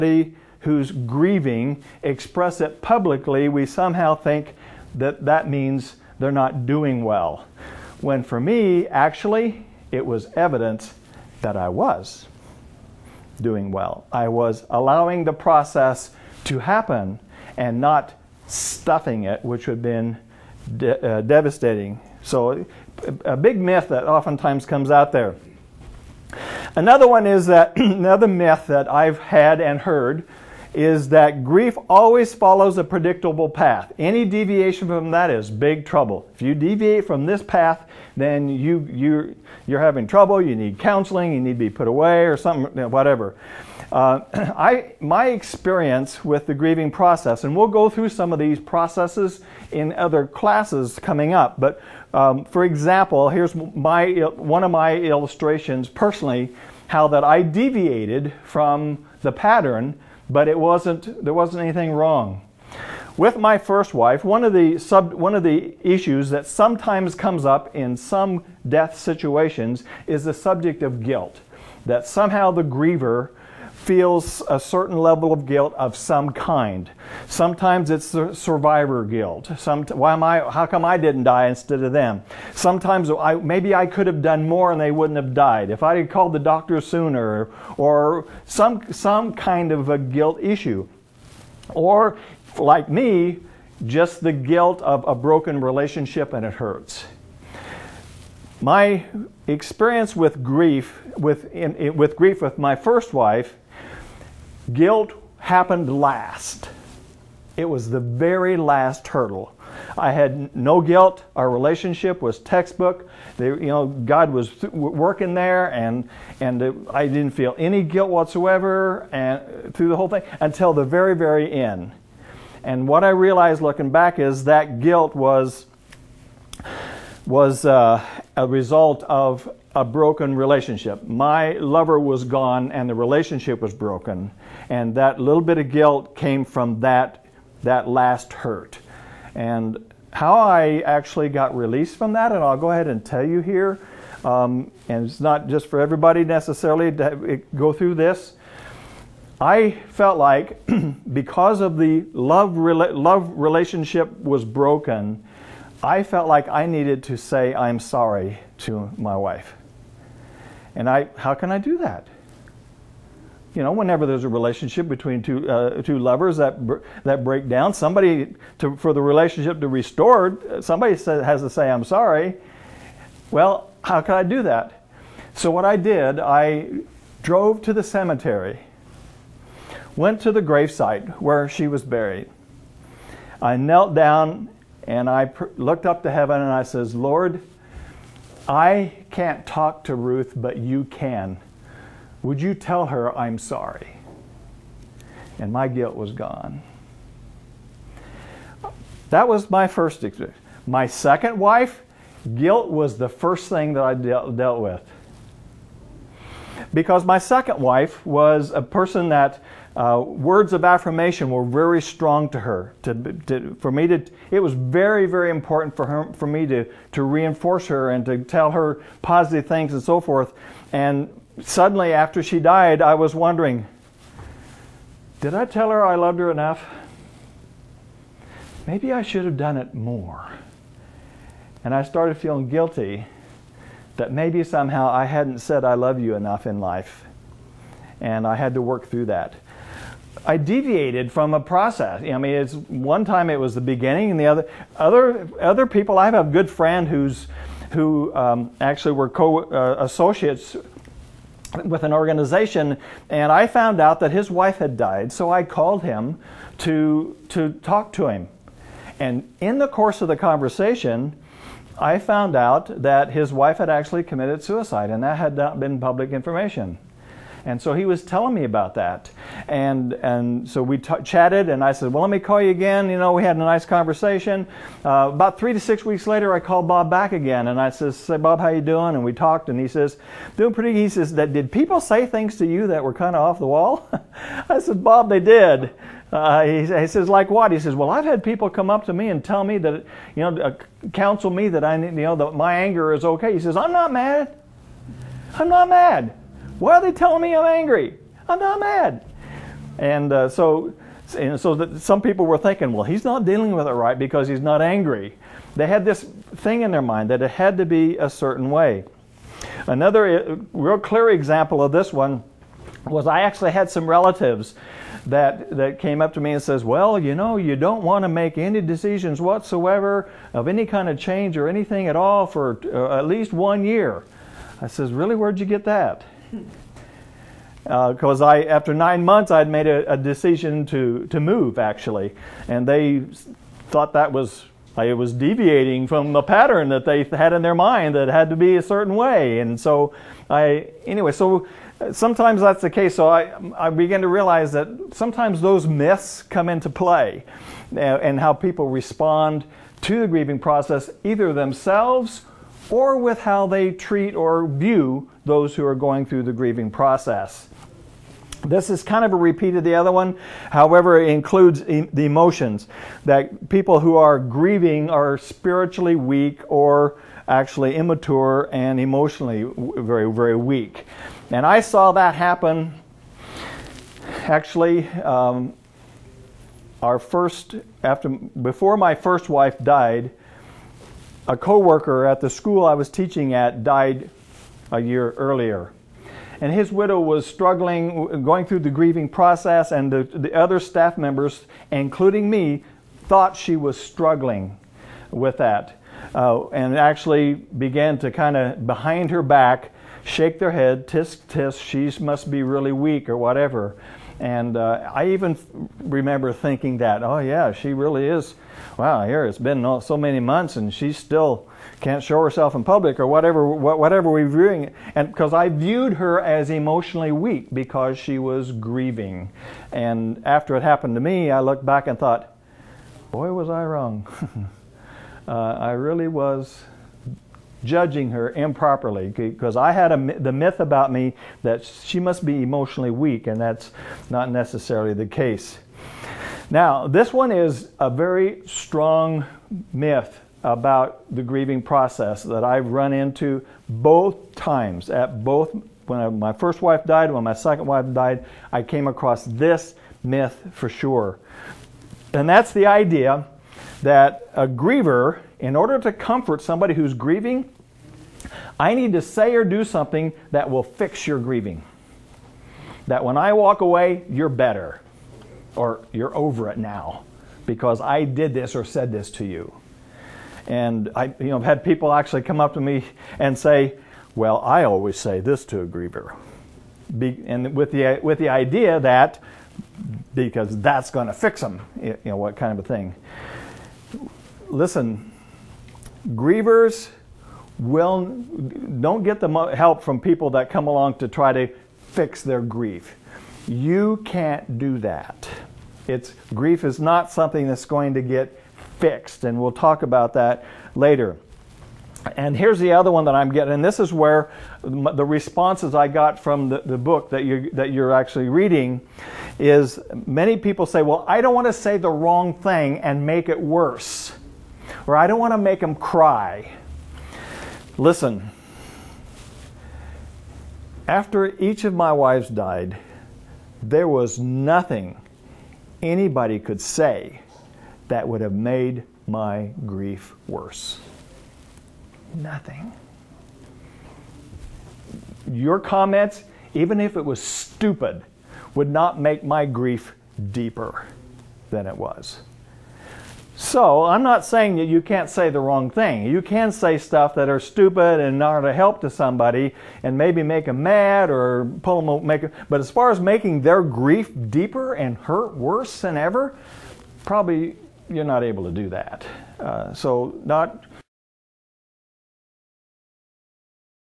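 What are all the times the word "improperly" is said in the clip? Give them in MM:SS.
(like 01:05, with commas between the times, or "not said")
07:08.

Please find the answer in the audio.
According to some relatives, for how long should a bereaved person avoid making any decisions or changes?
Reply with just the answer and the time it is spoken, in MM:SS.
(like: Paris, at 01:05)
1 year, at 05:23.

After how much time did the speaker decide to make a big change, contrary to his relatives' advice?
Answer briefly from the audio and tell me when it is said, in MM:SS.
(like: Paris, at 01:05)
9 months, at 05:28.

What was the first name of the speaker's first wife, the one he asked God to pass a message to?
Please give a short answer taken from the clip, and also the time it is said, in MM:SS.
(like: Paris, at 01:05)
Ruth, at 03:09.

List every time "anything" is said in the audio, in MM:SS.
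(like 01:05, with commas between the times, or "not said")
01:01, 05:21.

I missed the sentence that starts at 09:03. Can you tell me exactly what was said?
So I'm not saying that you can't say the wrong thing.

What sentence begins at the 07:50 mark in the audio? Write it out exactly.
And I, you know, I've had people actually come up to me and say, well, I always say this to a griever.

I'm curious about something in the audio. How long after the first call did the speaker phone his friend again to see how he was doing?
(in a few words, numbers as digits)
3 to 6 weeks.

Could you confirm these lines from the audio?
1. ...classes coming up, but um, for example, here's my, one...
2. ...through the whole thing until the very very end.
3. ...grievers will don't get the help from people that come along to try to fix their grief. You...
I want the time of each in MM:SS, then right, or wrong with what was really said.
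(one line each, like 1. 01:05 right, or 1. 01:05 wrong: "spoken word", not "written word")
1. 00:50 right
2. 01:59 right
3. 08:06 right.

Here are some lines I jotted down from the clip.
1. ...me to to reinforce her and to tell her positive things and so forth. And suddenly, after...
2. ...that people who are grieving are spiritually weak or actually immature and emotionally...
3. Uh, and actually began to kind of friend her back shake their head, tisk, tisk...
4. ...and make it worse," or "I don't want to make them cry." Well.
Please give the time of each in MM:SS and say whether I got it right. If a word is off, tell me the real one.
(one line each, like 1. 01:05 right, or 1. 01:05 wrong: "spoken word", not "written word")
1. 03:36 right
2. 06:03 right
3. 06:36 wrong: "behind", not "friend"
4. 08:32 wrong: "Listen", not "Well".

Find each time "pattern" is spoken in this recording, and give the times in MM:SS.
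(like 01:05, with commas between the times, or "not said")
00:59, 05:36.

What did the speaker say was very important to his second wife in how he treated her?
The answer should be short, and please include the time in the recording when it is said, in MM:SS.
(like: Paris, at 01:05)
Words of affirmation, at 03:30.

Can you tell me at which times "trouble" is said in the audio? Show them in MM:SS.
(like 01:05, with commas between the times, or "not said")
00:35, 00:40.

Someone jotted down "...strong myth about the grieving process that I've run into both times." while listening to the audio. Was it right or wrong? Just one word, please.
right.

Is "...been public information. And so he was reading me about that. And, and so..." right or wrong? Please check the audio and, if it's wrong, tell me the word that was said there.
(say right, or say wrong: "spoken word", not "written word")
wrong: "telling", not "reading".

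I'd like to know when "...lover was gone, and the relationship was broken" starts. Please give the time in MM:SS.
02:11.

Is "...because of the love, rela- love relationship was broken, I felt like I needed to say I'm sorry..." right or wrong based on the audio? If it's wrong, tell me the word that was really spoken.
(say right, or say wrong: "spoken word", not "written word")
right.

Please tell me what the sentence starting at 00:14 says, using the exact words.
I was allowing the process to happen and not stuffing it, which would have been de uh, devastating.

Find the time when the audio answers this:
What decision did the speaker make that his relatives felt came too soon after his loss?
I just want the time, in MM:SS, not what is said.
05:31.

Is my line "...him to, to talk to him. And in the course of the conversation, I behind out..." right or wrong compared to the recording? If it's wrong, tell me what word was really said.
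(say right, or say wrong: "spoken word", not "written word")
wrong: "found", not "behind".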